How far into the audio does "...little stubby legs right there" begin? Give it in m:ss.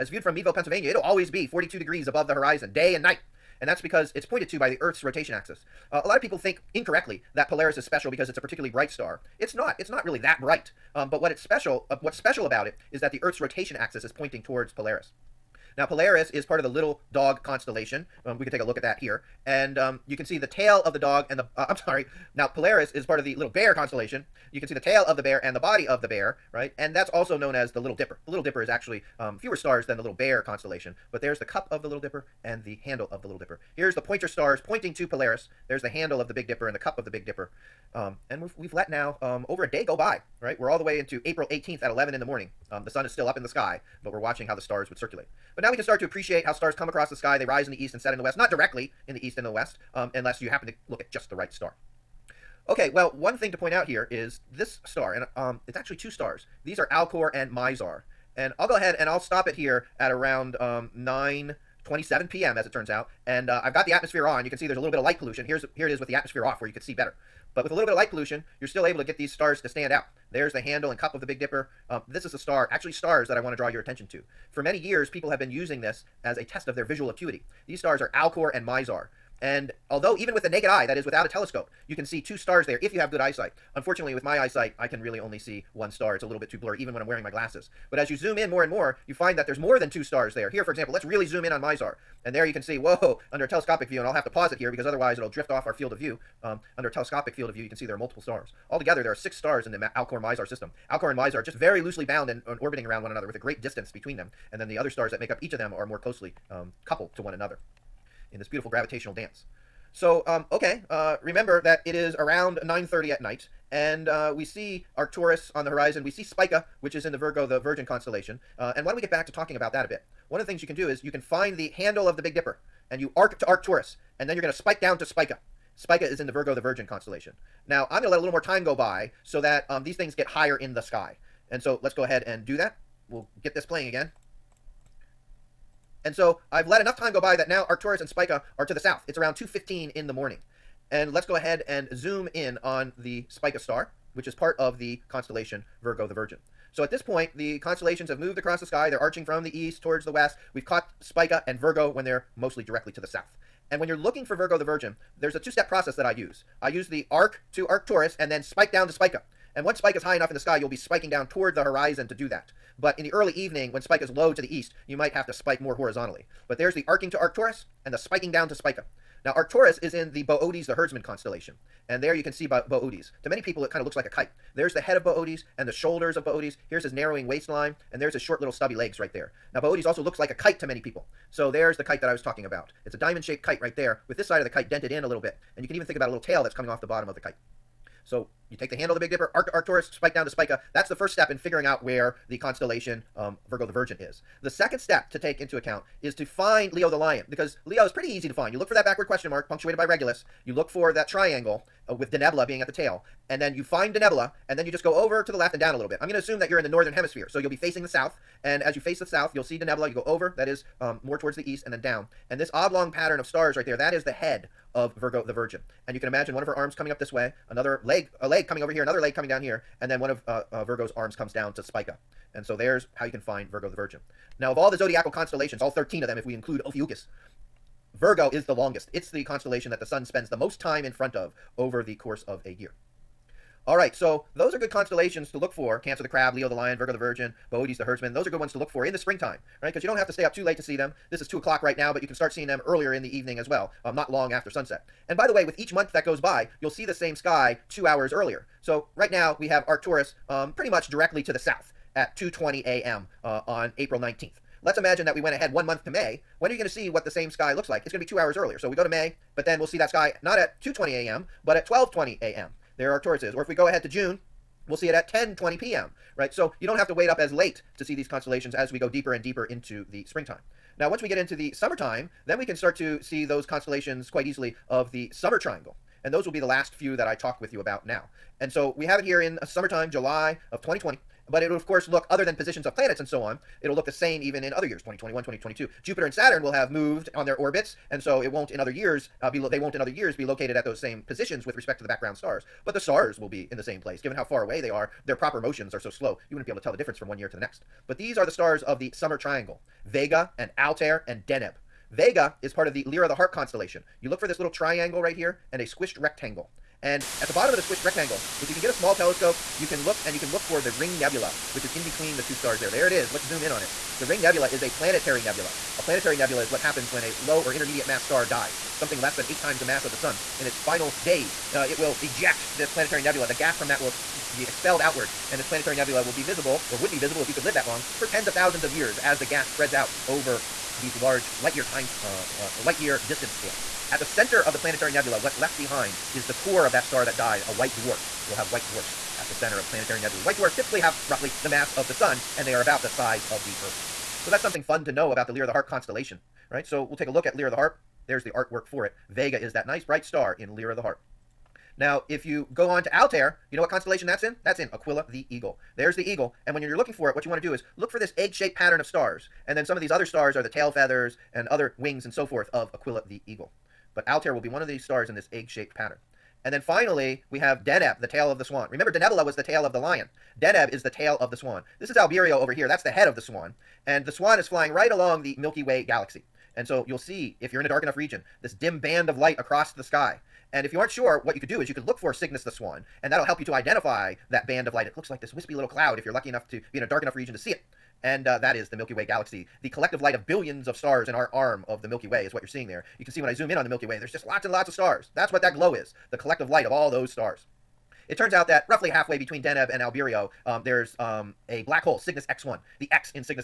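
2:58.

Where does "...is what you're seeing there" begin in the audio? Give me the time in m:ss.
6:32.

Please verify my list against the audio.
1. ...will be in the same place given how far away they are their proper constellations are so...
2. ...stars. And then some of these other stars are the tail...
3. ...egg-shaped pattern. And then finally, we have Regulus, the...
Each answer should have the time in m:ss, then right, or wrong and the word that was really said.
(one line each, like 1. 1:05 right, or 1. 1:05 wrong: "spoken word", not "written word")
1. 4:53 wrong: "motions", not "constellations"
2. 5:58 right
3. 6:05 wrong: "Deneb", not "Regulus".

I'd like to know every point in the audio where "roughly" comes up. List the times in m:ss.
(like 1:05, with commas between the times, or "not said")
5:41, 6:38.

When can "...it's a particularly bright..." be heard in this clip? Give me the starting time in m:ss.
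0:08.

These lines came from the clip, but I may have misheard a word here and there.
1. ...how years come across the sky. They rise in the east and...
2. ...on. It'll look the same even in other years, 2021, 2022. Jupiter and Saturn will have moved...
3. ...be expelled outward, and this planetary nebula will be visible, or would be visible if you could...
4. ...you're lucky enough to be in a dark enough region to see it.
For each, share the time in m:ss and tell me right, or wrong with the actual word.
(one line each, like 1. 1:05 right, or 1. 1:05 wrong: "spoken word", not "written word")
1. 0:46 wrong: "stars", not "years"
2. 4:43 right
3. 5:24 right
4. 6:26 right.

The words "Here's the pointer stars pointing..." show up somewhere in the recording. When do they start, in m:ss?
0:33.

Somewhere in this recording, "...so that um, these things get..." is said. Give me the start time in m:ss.
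2:09.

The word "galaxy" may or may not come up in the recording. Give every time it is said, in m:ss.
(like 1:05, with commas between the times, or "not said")
6:15, 6:29.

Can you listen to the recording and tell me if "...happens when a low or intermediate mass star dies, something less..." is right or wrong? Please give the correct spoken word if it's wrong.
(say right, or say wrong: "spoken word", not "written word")
right.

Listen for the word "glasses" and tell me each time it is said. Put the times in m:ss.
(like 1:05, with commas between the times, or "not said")
1:27.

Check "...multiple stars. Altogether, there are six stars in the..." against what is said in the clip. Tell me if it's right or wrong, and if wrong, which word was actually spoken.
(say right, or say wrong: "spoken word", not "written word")
right.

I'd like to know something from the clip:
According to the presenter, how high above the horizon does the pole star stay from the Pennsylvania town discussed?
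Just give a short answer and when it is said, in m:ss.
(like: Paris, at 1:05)
42 degrees, at 0:01.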